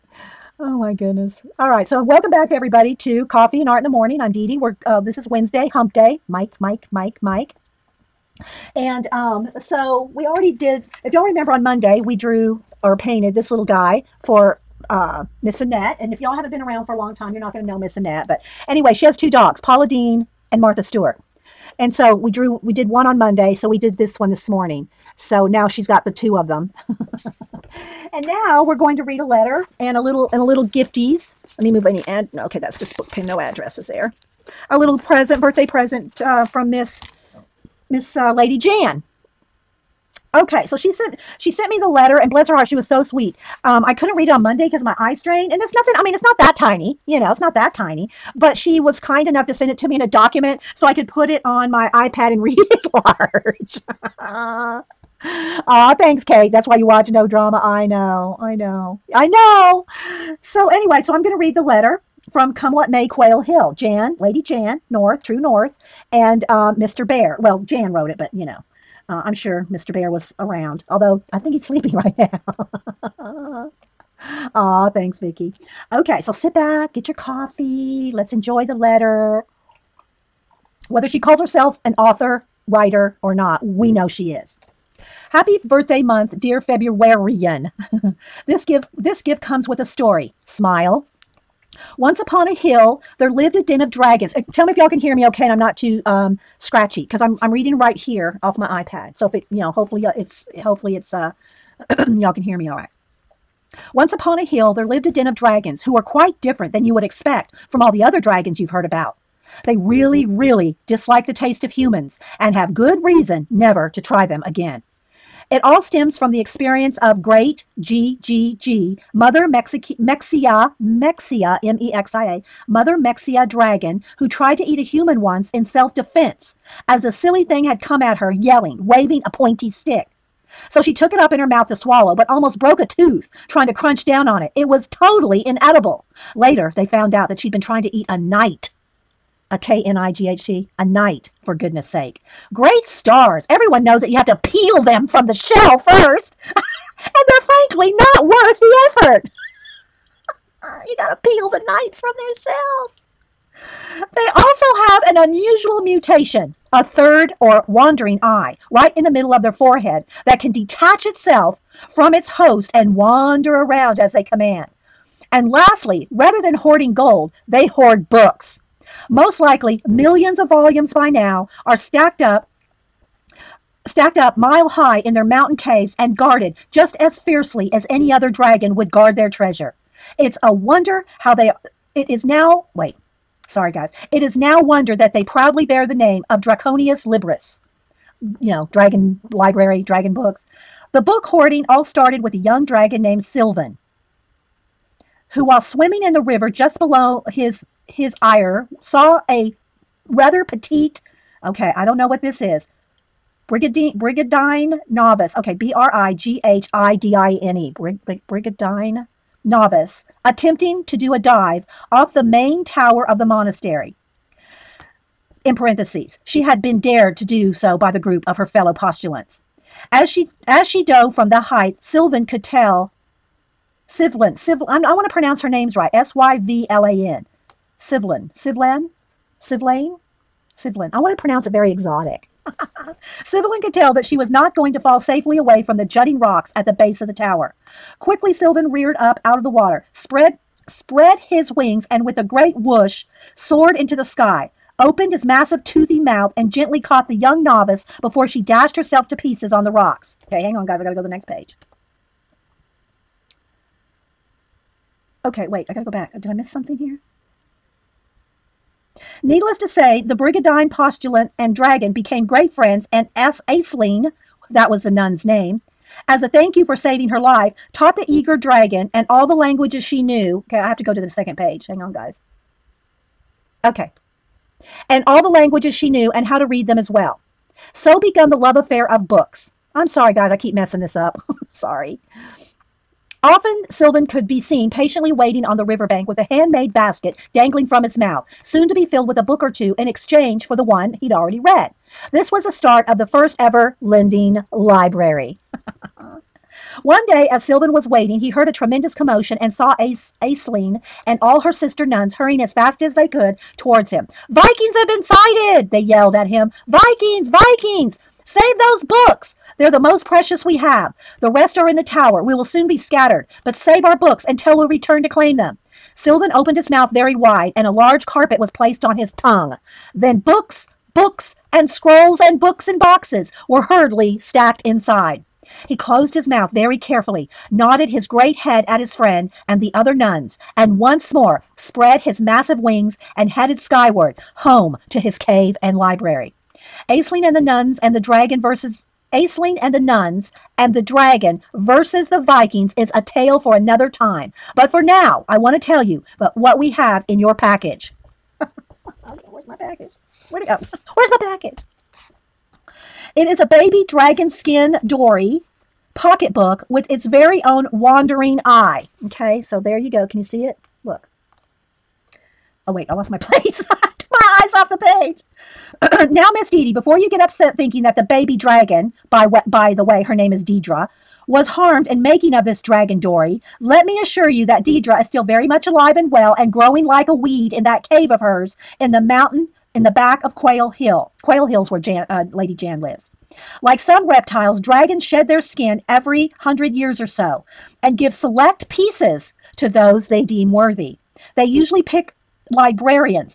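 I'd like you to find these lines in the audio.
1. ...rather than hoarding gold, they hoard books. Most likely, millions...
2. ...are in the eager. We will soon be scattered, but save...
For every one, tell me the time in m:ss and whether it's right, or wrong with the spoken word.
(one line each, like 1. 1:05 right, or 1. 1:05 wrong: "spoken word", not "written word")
1. 2:46 right
2. 5:11 wrong: "tower", not "eager".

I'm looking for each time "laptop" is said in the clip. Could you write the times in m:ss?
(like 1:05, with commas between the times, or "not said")
not said.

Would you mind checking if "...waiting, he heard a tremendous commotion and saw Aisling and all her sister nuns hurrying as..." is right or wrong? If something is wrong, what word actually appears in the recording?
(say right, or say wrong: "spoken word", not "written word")
right.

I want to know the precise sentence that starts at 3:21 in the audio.
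Okay, I don't know what this is.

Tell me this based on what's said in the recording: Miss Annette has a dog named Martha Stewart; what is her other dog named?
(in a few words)
Paula Deen.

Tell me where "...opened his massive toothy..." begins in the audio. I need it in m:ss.
4:04.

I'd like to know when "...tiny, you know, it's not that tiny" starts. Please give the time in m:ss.
0:46.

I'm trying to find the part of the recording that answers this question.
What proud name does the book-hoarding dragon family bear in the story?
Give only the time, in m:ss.
3:06.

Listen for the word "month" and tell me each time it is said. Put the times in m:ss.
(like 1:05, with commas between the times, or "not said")
1:25.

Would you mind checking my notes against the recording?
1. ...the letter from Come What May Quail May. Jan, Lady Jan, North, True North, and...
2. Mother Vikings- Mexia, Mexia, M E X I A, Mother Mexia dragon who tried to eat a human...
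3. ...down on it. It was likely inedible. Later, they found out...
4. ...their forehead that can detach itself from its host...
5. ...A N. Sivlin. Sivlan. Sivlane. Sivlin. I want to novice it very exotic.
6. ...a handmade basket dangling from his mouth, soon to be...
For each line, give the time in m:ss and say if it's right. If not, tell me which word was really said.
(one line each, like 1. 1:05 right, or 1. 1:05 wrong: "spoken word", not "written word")
1. 1:01 wrong: "Hill", not "May"
2. 1:59 wrong: "Mexi", not "Vikings"
3. 2:14 wrong: "totally", not "likely"
4. 2:39 right
5. 3:46 wrong: "pronounce", not "novice"
6. 4:46 right.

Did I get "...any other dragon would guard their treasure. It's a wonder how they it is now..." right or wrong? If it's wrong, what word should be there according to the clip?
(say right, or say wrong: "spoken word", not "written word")
right.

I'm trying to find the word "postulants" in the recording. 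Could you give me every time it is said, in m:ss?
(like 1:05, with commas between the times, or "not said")
3:38, 4:20.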